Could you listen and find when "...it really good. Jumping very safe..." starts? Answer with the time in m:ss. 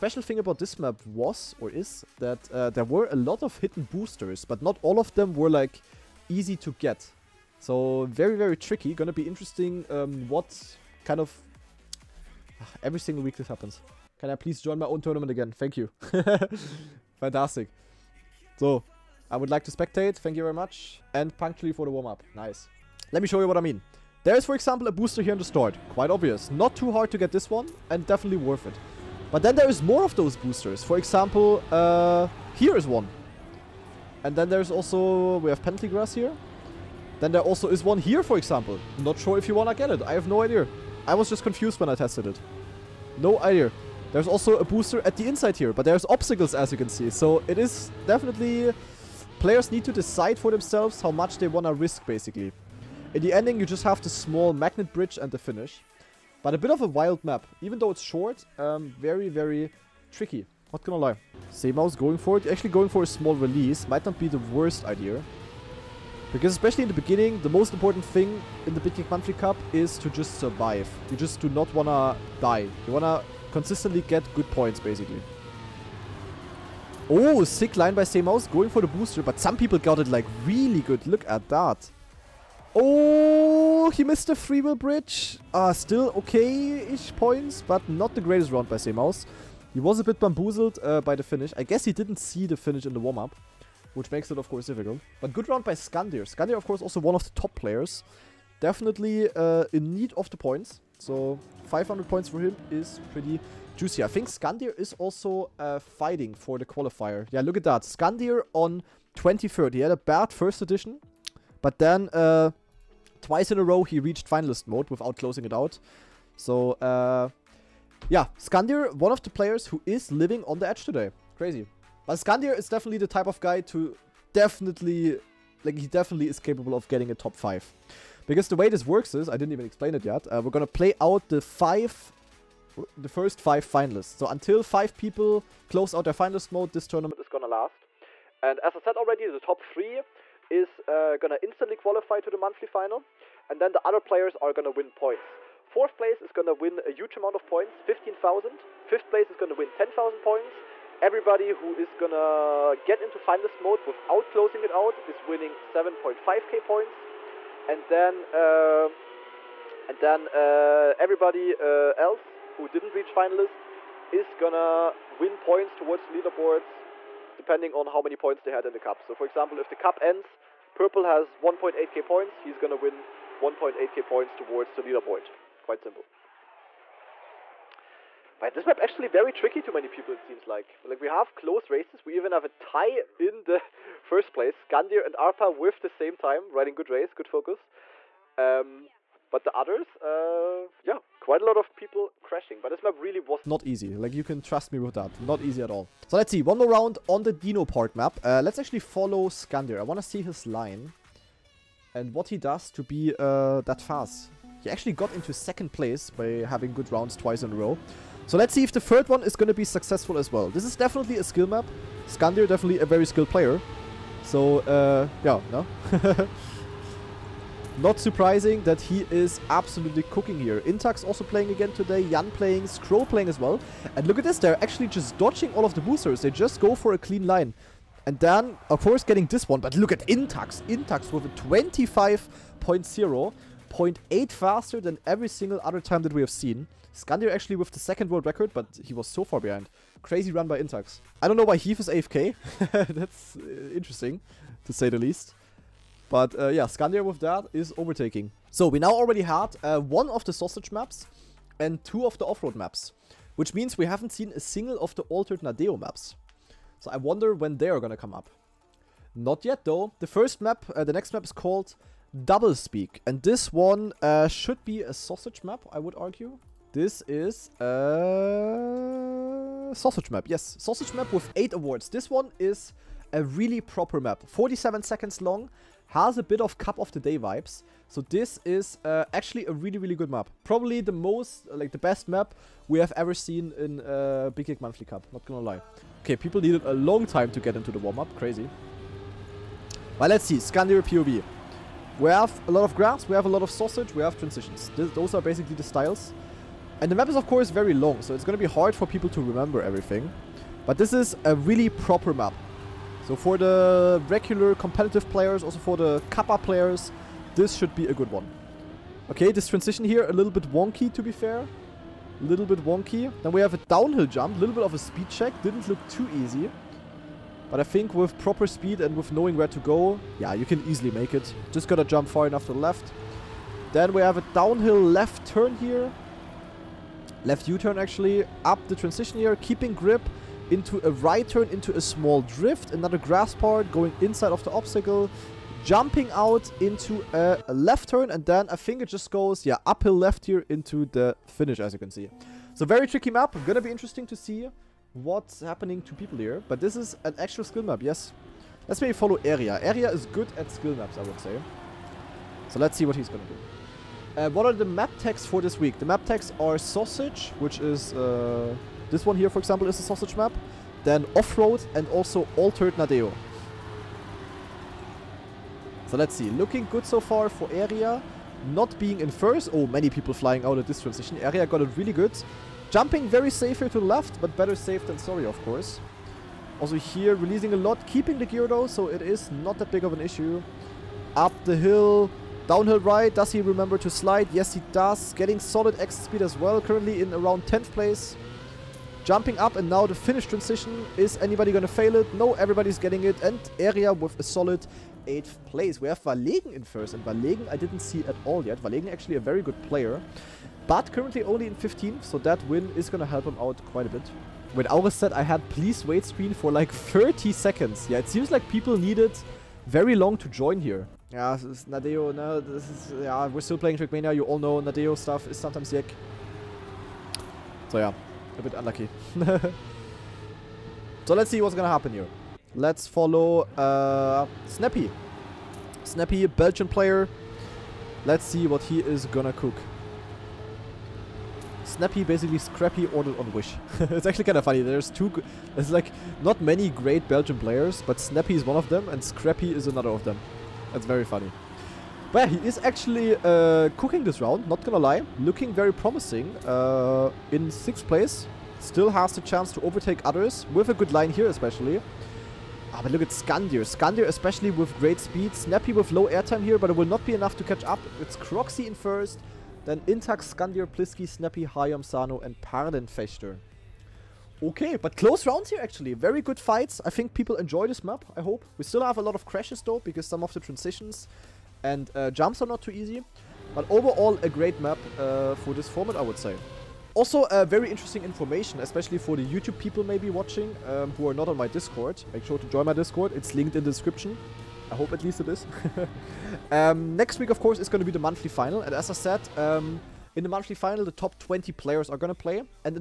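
6:11.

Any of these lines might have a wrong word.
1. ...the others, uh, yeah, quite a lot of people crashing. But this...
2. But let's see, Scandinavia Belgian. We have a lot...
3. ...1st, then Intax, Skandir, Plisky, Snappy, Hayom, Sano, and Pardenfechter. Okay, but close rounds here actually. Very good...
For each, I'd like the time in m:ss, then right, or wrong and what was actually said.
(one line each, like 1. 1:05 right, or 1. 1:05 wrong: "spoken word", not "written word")
1. 3:09 right
2. 4:49 wrong: "POV", not "Belgian"
3. 7:38 right.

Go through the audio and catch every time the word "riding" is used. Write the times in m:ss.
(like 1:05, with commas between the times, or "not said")
3:06.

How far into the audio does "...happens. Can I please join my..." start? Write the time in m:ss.
0:13.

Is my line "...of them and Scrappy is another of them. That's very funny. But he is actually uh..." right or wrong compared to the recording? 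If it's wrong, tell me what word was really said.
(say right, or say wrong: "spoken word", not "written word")
right.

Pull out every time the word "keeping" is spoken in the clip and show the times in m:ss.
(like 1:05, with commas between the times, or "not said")
5:29, 6:17.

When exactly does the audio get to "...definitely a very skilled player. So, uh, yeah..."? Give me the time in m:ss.
3:32.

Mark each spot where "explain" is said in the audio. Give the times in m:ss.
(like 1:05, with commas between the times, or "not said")
2:09.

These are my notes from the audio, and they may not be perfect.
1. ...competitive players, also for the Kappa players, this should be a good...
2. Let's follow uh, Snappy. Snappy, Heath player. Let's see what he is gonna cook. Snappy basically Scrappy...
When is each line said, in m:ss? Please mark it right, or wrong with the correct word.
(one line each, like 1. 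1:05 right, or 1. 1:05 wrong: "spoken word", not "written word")
1. 5:04 right
2. 7:02 wrong: "Belgian", not "Heath".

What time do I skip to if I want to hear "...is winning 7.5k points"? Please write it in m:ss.
2:35.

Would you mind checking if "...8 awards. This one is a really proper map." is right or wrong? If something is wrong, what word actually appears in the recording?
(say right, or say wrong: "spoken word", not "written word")
right.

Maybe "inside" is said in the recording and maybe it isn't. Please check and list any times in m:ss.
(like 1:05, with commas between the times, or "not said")
0:45, 5:33.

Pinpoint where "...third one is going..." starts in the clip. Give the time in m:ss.
3:28.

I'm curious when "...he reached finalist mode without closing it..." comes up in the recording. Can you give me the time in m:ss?
1:53.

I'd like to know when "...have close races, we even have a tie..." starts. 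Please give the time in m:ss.
3:01.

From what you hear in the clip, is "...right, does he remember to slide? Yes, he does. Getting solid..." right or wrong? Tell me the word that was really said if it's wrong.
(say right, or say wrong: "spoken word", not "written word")
right.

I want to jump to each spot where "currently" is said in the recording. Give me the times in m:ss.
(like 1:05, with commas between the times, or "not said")
6:26, 6:40.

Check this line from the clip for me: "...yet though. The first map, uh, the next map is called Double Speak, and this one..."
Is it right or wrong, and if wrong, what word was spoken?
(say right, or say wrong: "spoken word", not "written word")
right.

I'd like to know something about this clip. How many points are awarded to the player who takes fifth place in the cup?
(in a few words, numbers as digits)
10,000.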